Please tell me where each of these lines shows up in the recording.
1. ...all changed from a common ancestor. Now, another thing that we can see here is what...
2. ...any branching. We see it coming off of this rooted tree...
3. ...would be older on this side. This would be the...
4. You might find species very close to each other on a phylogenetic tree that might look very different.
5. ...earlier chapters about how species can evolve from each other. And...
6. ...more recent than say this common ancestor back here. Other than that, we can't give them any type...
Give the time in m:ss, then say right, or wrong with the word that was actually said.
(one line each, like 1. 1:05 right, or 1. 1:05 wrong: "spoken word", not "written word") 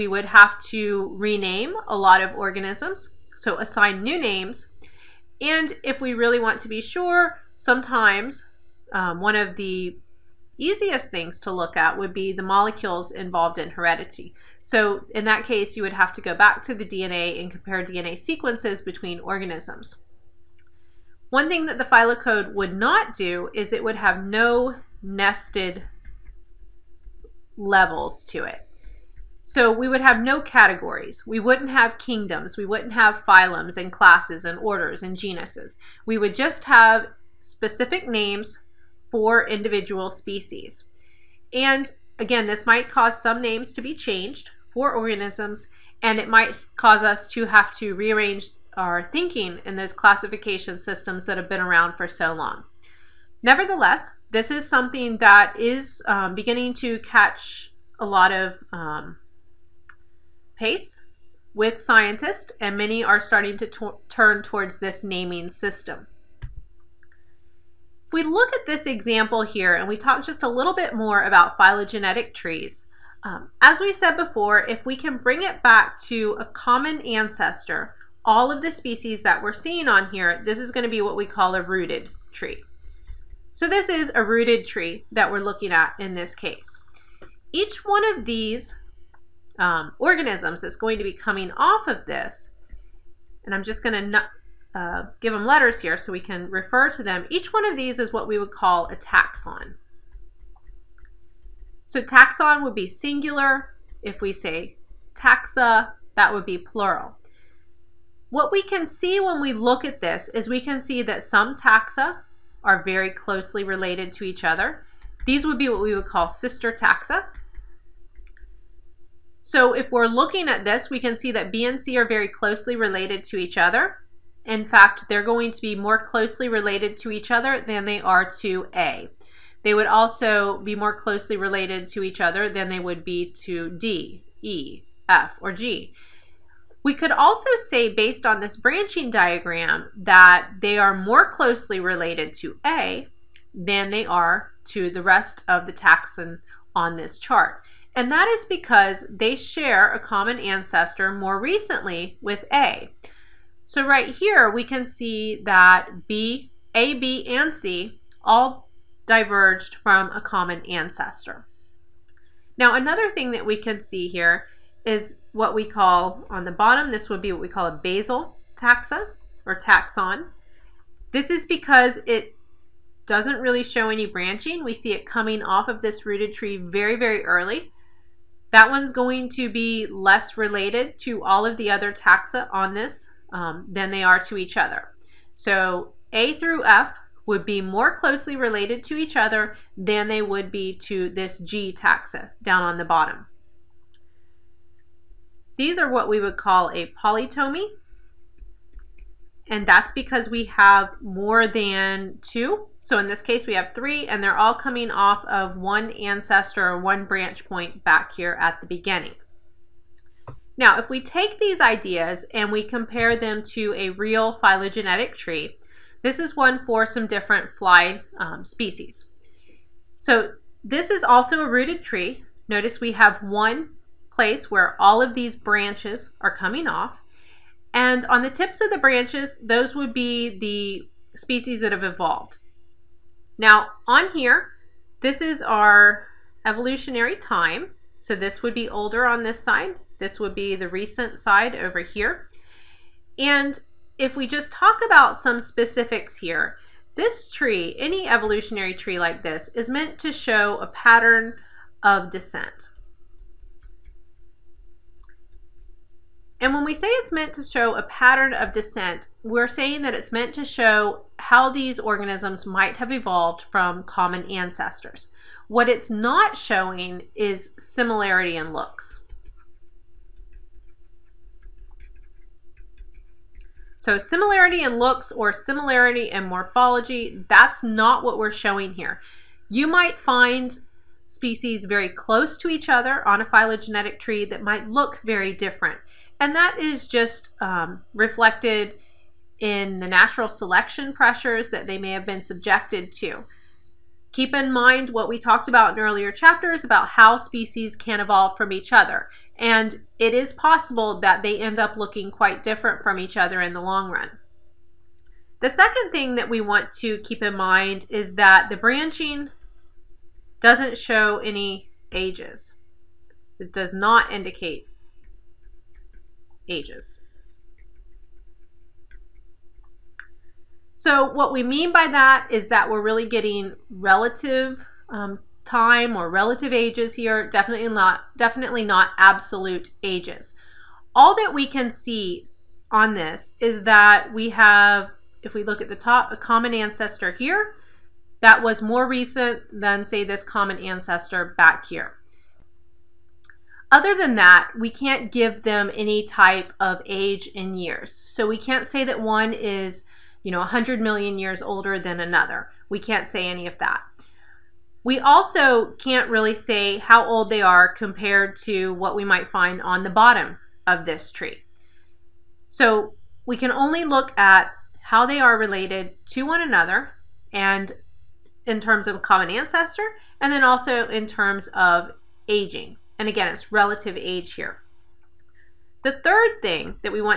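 1. 2:38 wrong: "diverged", not "changed"
2. 2:53 right
3. 3:58 right
4. 4:39 right
5. 4:55 right
6. 5:38 right.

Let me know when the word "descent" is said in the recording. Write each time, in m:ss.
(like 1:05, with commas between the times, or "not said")
4:12, 4:18.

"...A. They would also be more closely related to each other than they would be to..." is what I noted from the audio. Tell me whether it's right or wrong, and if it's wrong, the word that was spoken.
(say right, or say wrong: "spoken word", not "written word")
right.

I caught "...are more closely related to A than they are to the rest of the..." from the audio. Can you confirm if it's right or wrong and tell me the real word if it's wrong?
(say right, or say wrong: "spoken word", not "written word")
right.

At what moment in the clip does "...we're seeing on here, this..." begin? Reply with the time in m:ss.
1:19.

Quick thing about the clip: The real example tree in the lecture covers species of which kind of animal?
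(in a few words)
fly.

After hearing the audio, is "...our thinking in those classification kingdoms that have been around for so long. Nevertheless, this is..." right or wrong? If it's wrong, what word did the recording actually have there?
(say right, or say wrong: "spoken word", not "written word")
wrong: "systems", not "kingdoms".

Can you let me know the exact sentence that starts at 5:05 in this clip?
The second thing that we want to keep in mind is that the branching doesn't show any ages.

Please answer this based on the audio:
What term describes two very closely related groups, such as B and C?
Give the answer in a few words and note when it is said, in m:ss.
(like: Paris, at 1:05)
sister taxa, at 1:56.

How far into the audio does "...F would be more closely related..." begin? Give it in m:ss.
3:06.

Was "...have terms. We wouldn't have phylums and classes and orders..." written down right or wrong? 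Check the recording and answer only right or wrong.
wrong.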